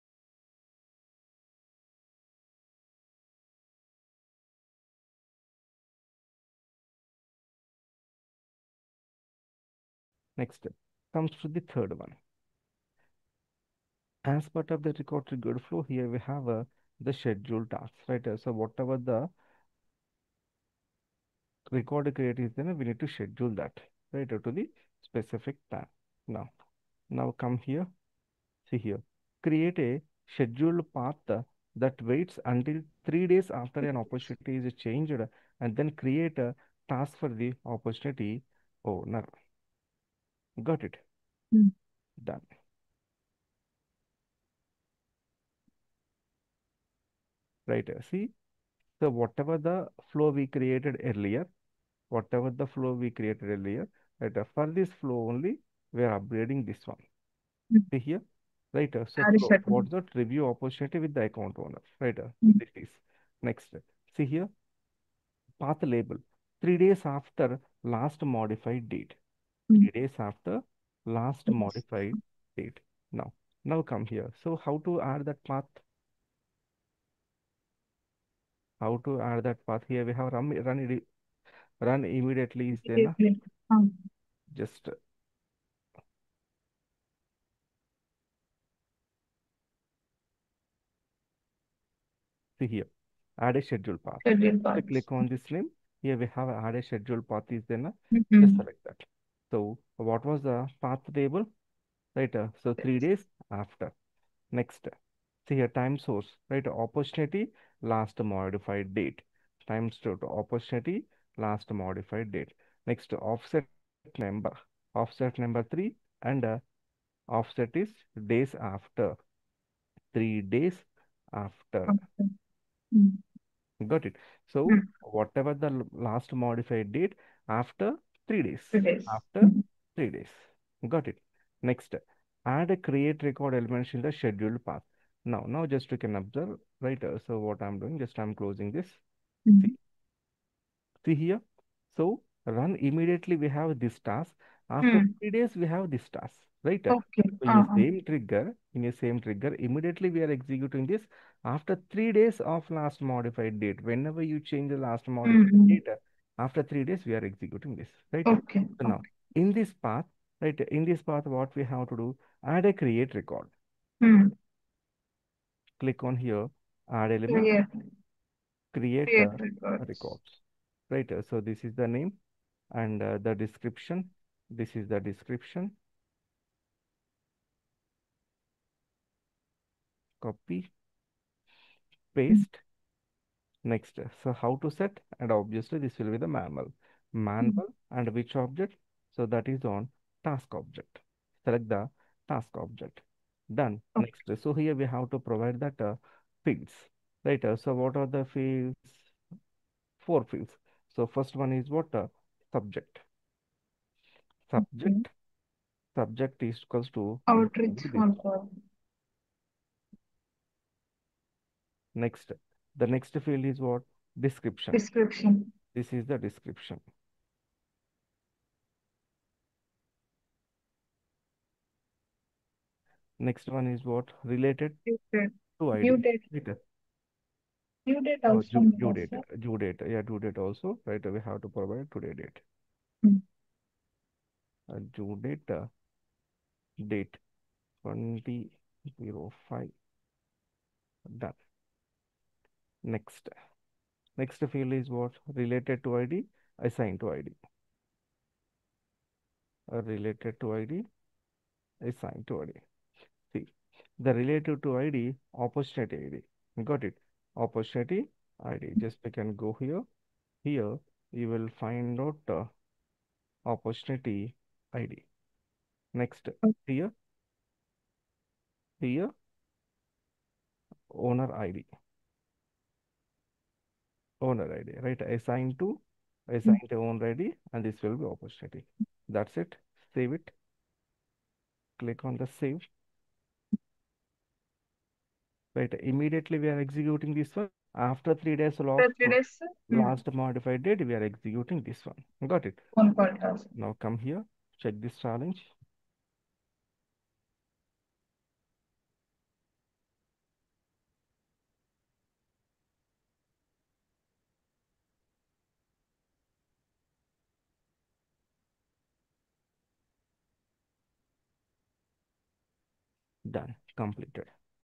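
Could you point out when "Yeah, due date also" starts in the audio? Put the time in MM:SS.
03:49.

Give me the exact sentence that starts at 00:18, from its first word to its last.
Uh, so whatever the record create is then we need to schedule that, right, uh, to the specific plan.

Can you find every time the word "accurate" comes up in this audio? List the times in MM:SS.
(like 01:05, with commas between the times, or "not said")
not said.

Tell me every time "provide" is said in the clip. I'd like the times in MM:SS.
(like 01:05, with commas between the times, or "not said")
03:15, 03:51.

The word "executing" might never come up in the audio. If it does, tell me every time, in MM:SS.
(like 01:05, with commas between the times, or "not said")
02:30, 02:37, 04:46, 04:51.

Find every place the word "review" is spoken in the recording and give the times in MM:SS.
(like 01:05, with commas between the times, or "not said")
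01:00.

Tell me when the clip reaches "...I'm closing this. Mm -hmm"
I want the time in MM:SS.
02:18.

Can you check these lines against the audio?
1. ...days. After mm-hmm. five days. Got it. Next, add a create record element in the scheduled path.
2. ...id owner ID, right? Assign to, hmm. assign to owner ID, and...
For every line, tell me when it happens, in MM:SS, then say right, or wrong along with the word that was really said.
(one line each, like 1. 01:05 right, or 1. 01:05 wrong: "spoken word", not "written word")
1. 02:08 wrong: "three", not "five"
2. 04:31 right.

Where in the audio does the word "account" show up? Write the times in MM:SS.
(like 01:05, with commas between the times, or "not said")
01:01.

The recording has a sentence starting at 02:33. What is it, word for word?
Whenever you change the last modified mm -hmm.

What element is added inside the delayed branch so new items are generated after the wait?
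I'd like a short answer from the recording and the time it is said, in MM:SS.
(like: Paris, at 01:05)
Create records, at 02:48.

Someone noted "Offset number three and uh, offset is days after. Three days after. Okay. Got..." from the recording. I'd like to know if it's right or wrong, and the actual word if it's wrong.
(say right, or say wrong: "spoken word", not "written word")
right.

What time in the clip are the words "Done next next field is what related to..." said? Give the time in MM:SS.
04:01.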